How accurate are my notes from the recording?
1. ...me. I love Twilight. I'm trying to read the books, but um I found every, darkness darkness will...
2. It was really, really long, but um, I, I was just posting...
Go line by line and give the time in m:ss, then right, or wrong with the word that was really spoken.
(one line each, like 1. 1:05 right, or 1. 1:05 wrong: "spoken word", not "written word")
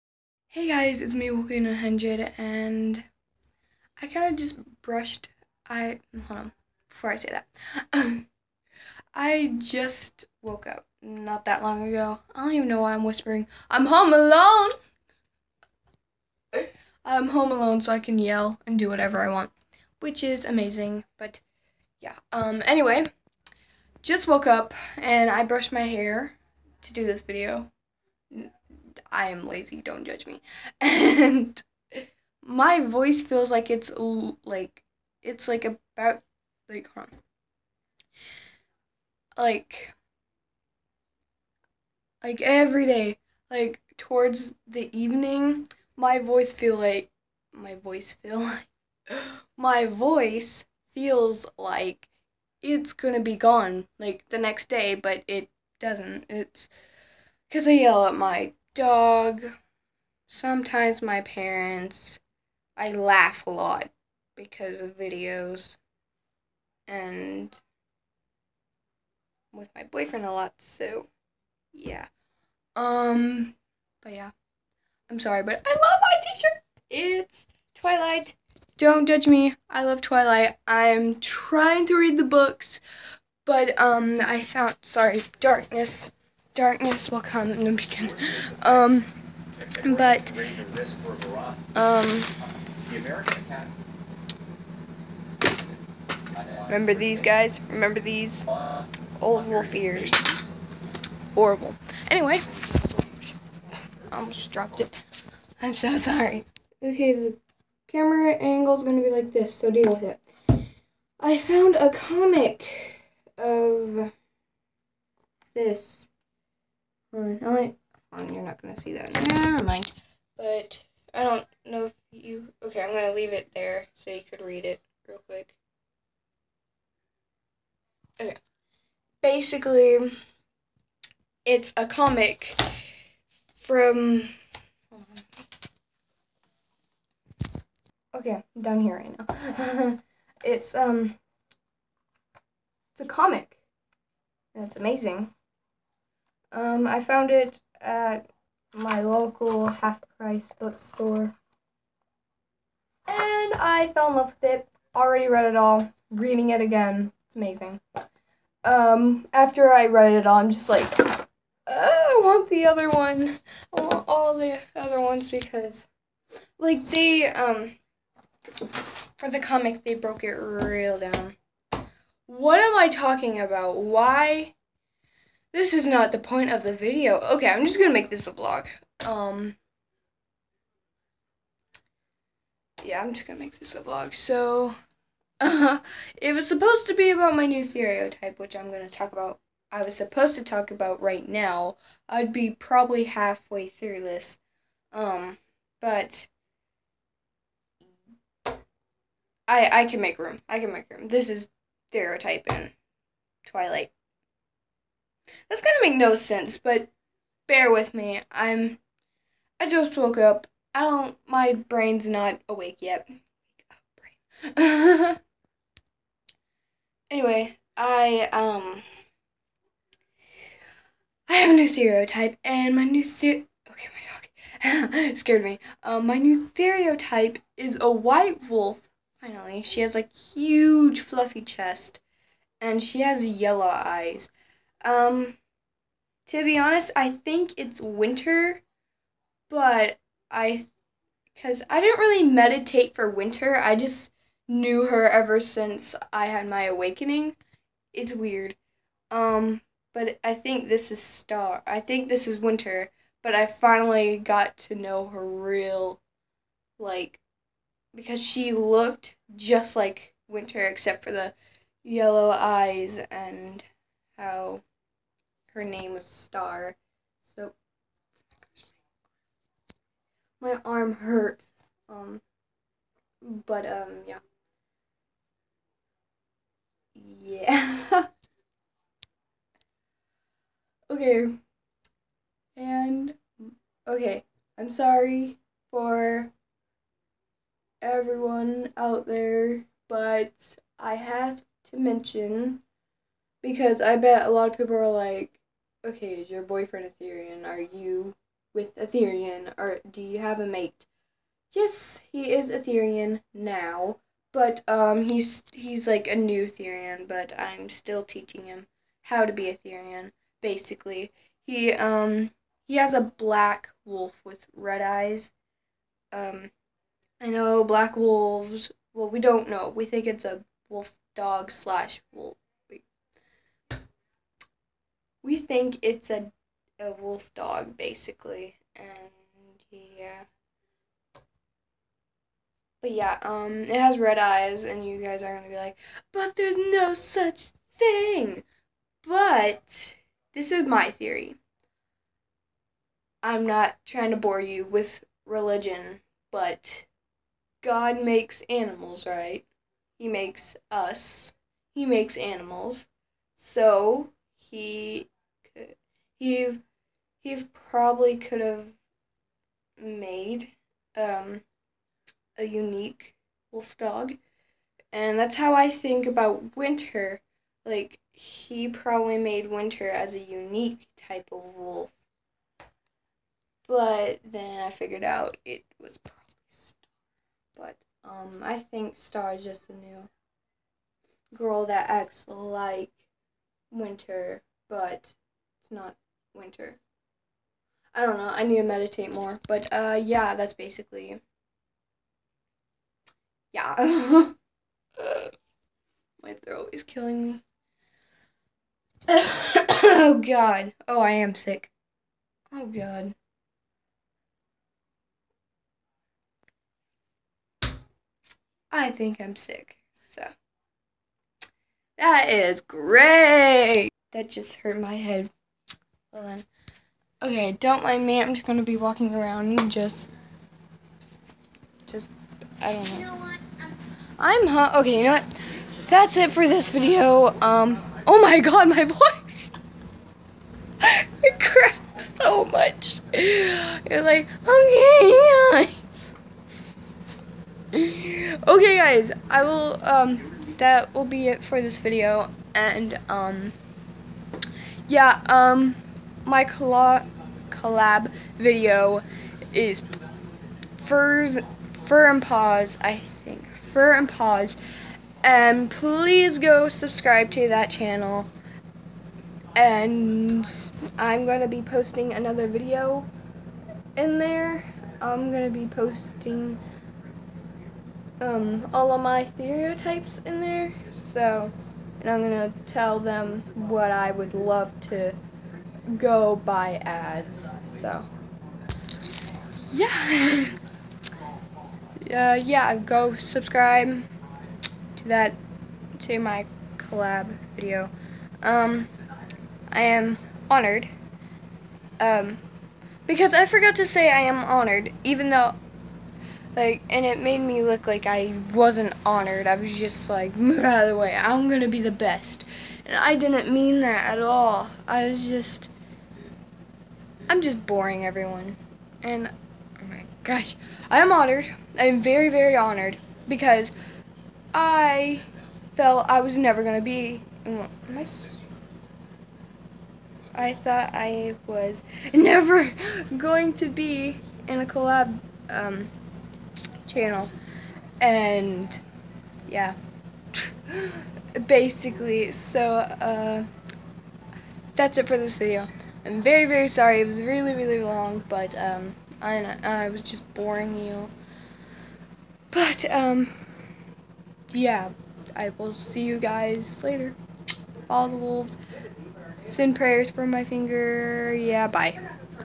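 1. 1:19 wrong: "sorry", not "every"
2. 8:57 wrong: "boring", not "posting".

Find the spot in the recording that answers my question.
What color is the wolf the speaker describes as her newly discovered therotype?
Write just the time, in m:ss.
3:47.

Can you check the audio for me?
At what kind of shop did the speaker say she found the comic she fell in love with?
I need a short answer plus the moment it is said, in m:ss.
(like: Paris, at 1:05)
Half-price bookstore, at 2:29.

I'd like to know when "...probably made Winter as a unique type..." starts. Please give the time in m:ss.
6:08.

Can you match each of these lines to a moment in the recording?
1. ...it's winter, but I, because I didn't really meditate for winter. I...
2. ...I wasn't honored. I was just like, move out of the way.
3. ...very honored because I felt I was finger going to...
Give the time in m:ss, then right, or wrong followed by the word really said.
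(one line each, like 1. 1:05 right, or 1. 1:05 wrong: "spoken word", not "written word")
1. 3:57 right
2. 8:18 right
3. 8:32 wrong: "never", not "finger".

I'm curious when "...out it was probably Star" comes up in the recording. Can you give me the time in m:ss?
6:15.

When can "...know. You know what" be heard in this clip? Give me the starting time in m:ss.
7:02.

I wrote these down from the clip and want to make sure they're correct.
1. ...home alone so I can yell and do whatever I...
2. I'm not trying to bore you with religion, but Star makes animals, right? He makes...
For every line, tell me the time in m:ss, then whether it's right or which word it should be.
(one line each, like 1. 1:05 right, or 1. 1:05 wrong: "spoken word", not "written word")
1. 0:17 right
2. 5:43 wrong: "God", not "Star".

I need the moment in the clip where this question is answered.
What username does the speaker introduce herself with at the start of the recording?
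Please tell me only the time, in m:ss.
0:01.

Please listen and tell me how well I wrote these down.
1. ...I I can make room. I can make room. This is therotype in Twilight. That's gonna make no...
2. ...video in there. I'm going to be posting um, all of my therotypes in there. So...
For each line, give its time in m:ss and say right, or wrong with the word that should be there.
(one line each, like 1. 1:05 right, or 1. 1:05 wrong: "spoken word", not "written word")
1. 3:19 right
2. 7:42 right.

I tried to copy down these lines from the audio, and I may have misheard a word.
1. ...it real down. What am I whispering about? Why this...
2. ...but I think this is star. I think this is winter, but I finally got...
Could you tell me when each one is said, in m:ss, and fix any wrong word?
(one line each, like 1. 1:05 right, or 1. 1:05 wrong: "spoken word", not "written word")
1. 2:50 wrong: "talking", not "whispering"
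2. 4:09 right.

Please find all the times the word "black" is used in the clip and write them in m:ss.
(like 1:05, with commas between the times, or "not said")
5:13, 5:17.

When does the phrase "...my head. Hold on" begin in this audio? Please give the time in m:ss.
6:54.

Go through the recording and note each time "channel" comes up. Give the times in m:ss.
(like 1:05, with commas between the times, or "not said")
7:37, 8:46.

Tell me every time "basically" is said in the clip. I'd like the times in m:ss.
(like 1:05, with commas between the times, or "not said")
2:09, 5:10, 5:27, 6:30, 8:51.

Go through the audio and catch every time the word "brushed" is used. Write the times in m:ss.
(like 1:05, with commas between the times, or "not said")
0:04, 0:25.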